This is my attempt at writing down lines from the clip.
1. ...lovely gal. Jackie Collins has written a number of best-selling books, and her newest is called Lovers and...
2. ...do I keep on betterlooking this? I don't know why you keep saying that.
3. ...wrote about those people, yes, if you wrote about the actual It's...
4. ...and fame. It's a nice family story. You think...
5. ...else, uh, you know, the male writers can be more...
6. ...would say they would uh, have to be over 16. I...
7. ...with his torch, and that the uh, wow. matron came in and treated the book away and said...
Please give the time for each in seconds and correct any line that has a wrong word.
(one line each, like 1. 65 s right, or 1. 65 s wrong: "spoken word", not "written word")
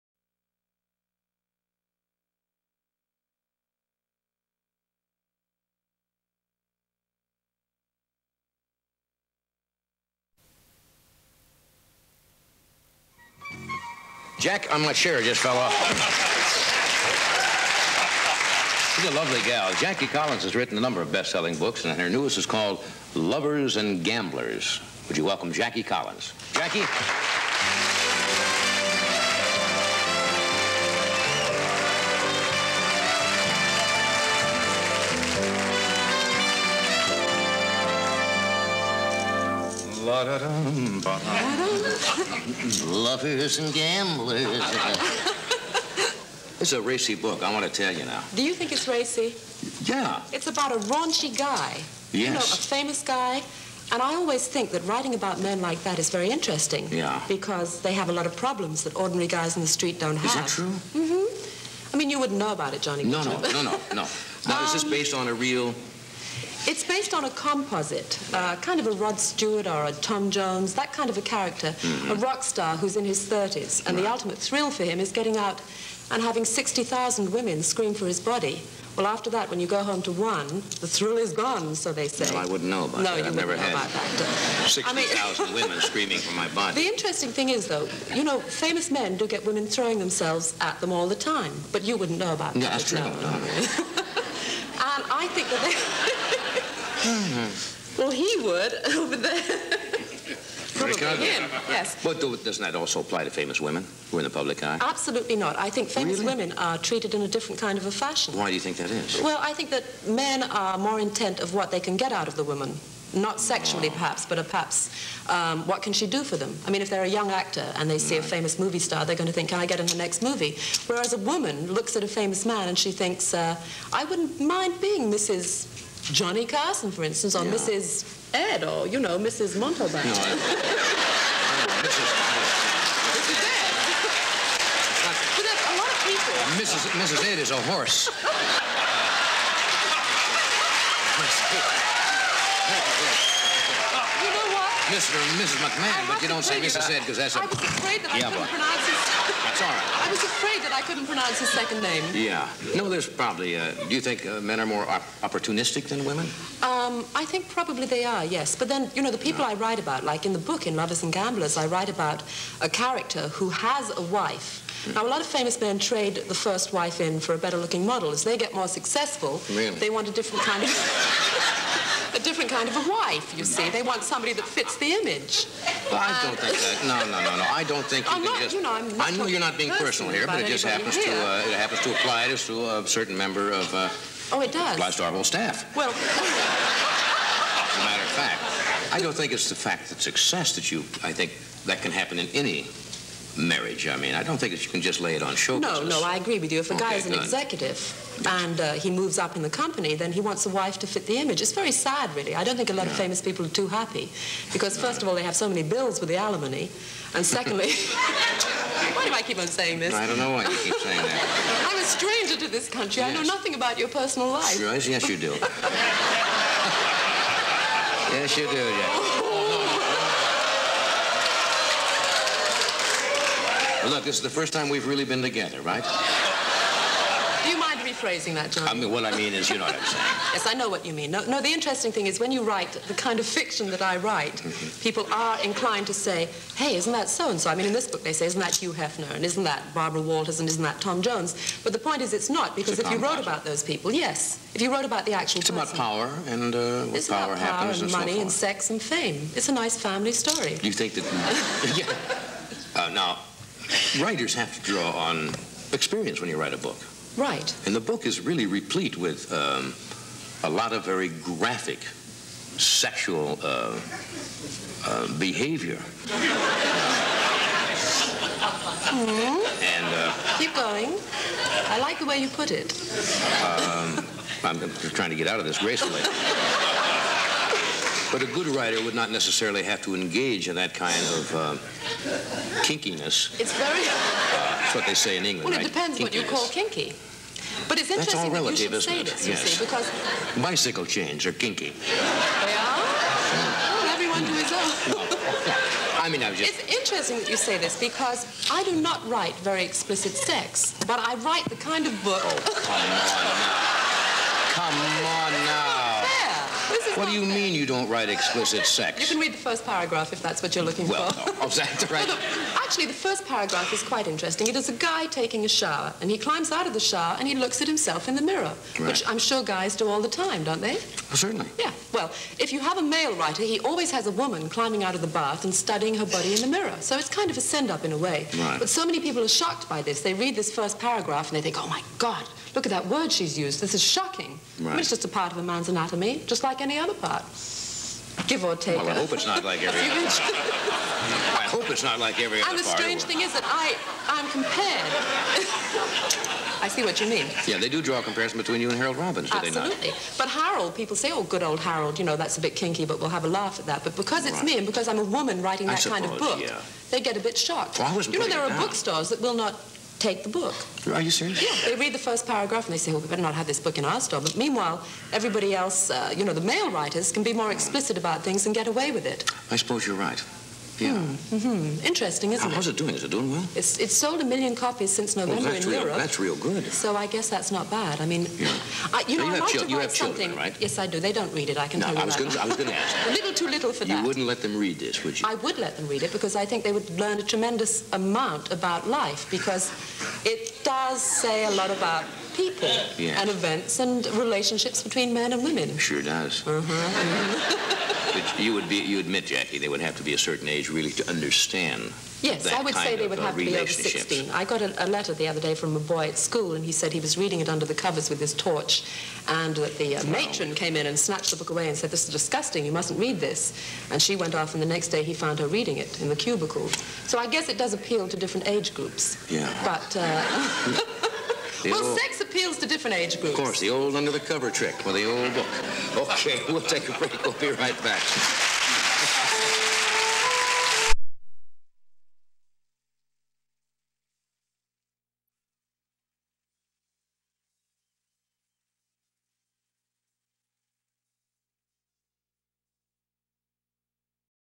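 1. 19 s right
2. 209 s wrong: "saying", not "betterlooking"
3. 243 s right
4. 248 s right
5. 365 s right
6. 402 s right
7. 408 s wrong: "snatched", not "treated".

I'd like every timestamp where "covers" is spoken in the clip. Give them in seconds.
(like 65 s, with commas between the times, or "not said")
407 s, 424 s.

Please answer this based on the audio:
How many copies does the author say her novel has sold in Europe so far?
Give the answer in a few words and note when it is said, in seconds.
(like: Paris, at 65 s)
a million, at 374 s.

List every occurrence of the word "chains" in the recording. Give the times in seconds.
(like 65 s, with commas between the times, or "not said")
290 s.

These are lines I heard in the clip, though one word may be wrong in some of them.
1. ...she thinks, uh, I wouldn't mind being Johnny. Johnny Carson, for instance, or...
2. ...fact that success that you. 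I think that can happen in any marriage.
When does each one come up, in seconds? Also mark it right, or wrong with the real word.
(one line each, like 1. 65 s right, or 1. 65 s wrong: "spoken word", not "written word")
1. 122 s wrong: "Mrs", not "Johnny"
2. 189 s right.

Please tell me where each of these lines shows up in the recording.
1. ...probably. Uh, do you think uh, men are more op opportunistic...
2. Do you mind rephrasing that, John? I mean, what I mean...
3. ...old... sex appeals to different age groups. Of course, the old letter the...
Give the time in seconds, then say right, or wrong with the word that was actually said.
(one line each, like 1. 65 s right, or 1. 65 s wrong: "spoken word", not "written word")
1. 153 s right
2. 227 s right
3. 421 s wrong: "under", not "letter".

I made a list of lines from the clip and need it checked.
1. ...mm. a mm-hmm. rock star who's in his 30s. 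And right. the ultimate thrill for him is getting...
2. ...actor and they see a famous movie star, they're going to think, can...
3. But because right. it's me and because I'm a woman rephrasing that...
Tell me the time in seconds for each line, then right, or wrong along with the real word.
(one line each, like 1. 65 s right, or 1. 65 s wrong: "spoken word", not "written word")
1. 71 s right
2. 117 s right
3. 353 s wrong: "writing", not "rephrasing".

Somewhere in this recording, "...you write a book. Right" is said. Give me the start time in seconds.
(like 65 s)
256 s.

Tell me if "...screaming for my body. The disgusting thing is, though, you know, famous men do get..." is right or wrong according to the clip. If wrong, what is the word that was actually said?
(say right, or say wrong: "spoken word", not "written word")
wrong: "interesting", not "disgusting".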